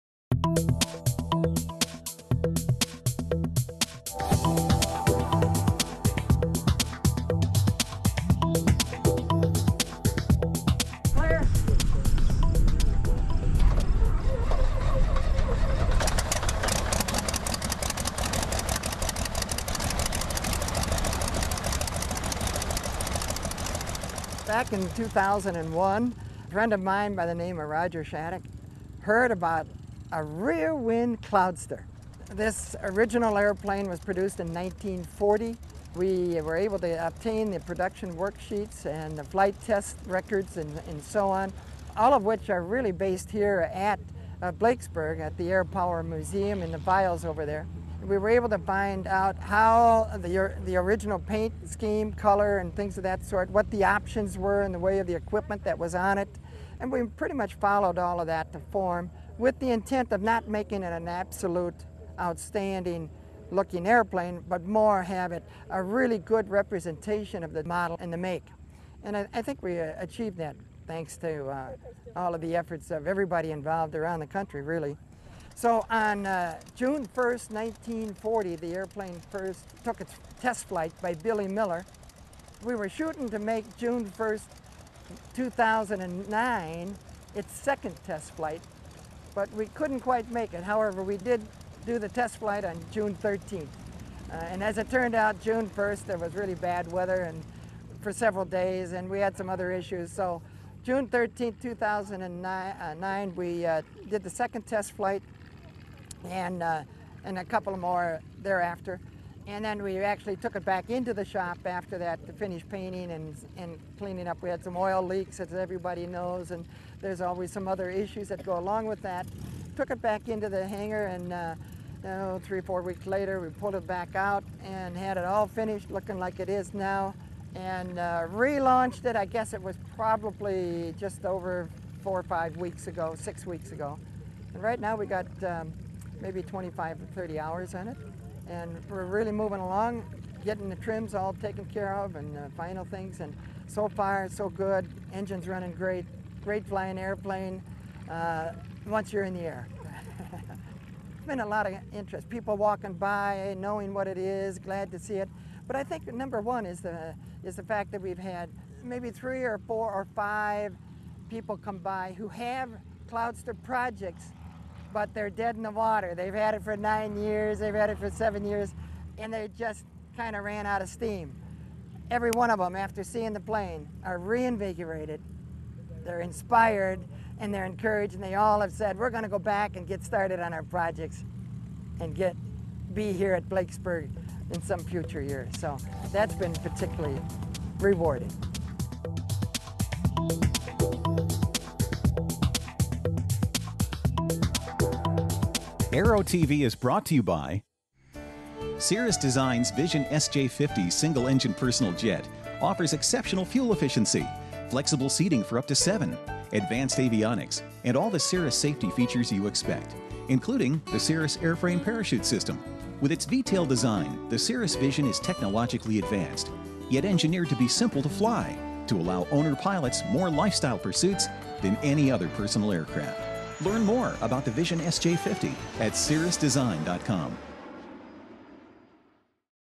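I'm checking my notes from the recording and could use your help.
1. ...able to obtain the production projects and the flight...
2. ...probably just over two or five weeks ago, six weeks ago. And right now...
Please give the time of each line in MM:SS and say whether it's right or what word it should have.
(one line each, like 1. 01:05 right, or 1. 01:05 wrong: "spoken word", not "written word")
1. 00:36 wrong: "worksheets", not "projects"
2. 02:09 wrong: "four", not "two".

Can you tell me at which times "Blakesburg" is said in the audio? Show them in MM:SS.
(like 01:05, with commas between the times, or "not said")
00:44, 03:03.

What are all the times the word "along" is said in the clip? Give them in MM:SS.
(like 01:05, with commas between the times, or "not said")
01:58, 02:19.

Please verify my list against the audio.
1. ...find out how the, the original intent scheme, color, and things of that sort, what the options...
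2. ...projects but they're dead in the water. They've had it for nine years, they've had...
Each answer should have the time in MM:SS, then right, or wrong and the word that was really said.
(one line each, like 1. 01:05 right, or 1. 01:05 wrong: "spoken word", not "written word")
1. 00:48 wrong: "paint", not "intent"
2. 02:43 right.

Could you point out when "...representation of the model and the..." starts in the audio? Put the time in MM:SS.
01:06.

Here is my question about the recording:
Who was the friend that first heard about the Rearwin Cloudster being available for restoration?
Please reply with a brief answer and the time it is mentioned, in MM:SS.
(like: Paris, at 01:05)
Roger Shattuck, at 00:27.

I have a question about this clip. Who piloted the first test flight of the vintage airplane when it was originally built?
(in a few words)
Billy Miller.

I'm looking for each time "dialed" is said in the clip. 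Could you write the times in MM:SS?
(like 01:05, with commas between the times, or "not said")
not said.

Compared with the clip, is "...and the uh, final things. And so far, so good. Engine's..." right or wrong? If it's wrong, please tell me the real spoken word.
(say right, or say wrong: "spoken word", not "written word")
right.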